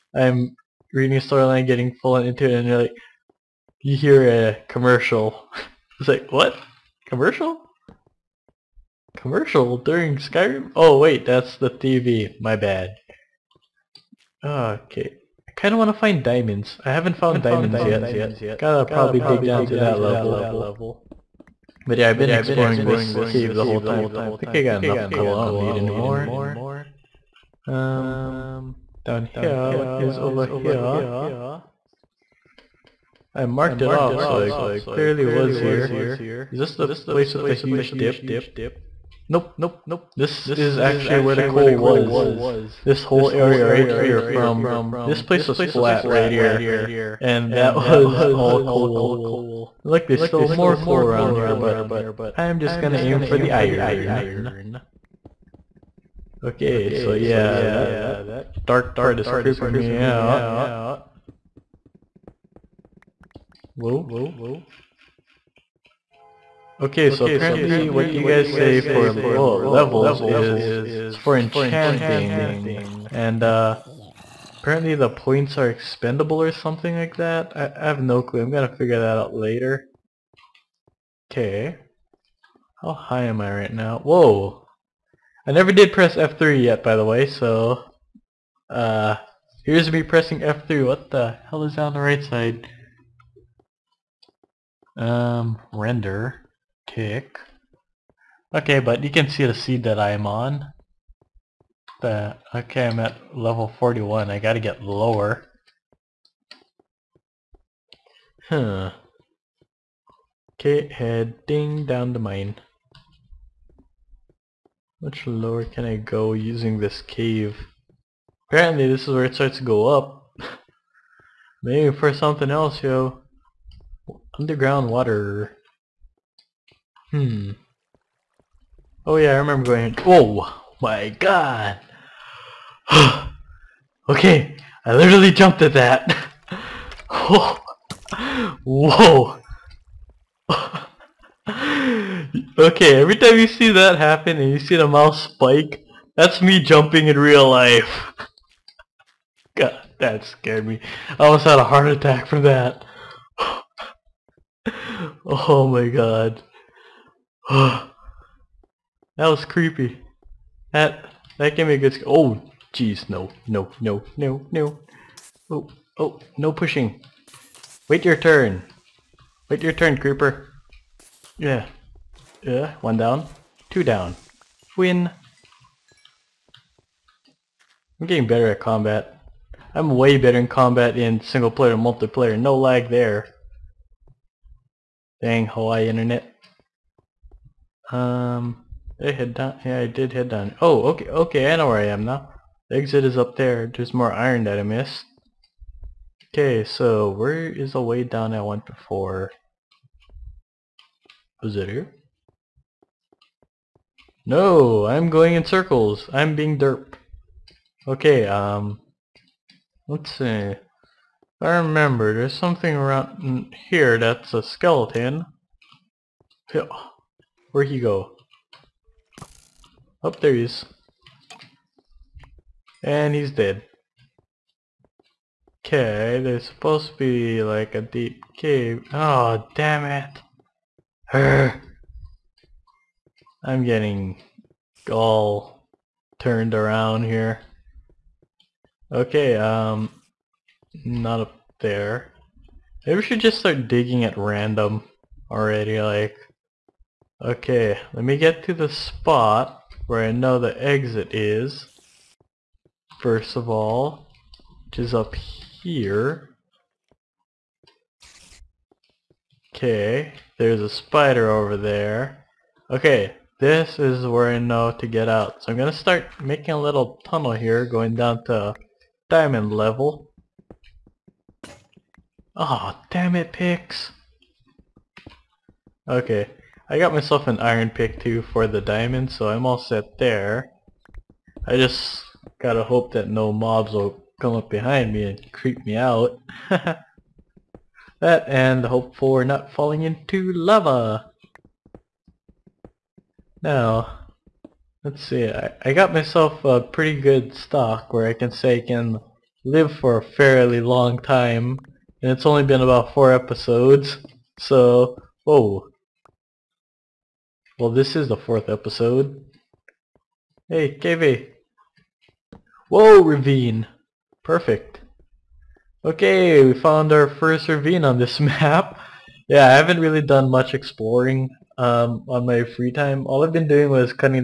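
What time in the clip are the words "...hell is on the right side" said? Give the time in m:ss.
1:31.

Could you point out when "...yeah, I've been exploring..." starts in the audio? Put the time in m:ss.
0:21.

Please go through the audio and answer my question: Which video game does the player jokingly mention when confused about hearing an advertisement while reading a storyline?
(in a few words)
Skyrim.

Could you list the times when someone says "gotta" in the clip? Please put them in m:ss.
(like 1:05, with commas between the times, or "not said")
0:18, 1:44, 4:42.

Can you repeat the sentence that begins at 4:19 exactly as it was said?
Okay, there's a spider over there.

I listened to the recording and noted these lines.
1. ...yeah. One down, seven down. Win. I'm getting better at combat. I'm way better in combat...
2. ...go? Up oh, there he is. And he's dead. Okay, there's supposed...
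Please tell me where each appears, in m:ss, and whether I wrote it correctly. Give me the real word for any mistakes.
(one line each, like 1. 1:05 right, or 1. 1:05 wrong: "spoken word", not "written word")
1. 2:52 wrong: "two", not "seven"
2. 3:37 right.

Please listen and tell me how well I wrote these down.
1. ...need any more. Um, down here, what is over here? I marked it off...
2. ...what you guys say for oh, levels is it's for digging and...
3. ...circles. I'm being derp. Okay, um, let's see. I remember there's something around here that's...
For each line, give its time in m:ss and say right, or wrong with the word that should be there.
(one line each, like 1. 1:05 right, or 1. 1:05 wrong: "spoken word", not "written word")
1. 0:25 right
2. 1:07 wrong: "enchanting", not "digging"
3. 3:25 right.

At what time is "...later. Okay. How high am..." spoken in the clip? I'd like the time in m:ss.
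1:19.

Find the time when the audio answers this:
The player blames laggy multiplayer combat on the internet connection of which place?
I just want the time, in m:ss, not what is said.
3:05.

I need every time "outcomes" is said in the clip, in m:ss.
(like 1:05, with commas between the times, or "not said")
not said.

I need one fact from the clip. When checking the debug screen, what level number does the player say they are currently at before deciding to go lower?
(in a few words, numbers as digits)
41.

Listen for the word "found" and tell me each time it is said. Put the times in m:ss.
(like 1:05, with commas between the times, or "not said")
0:17, 5:16.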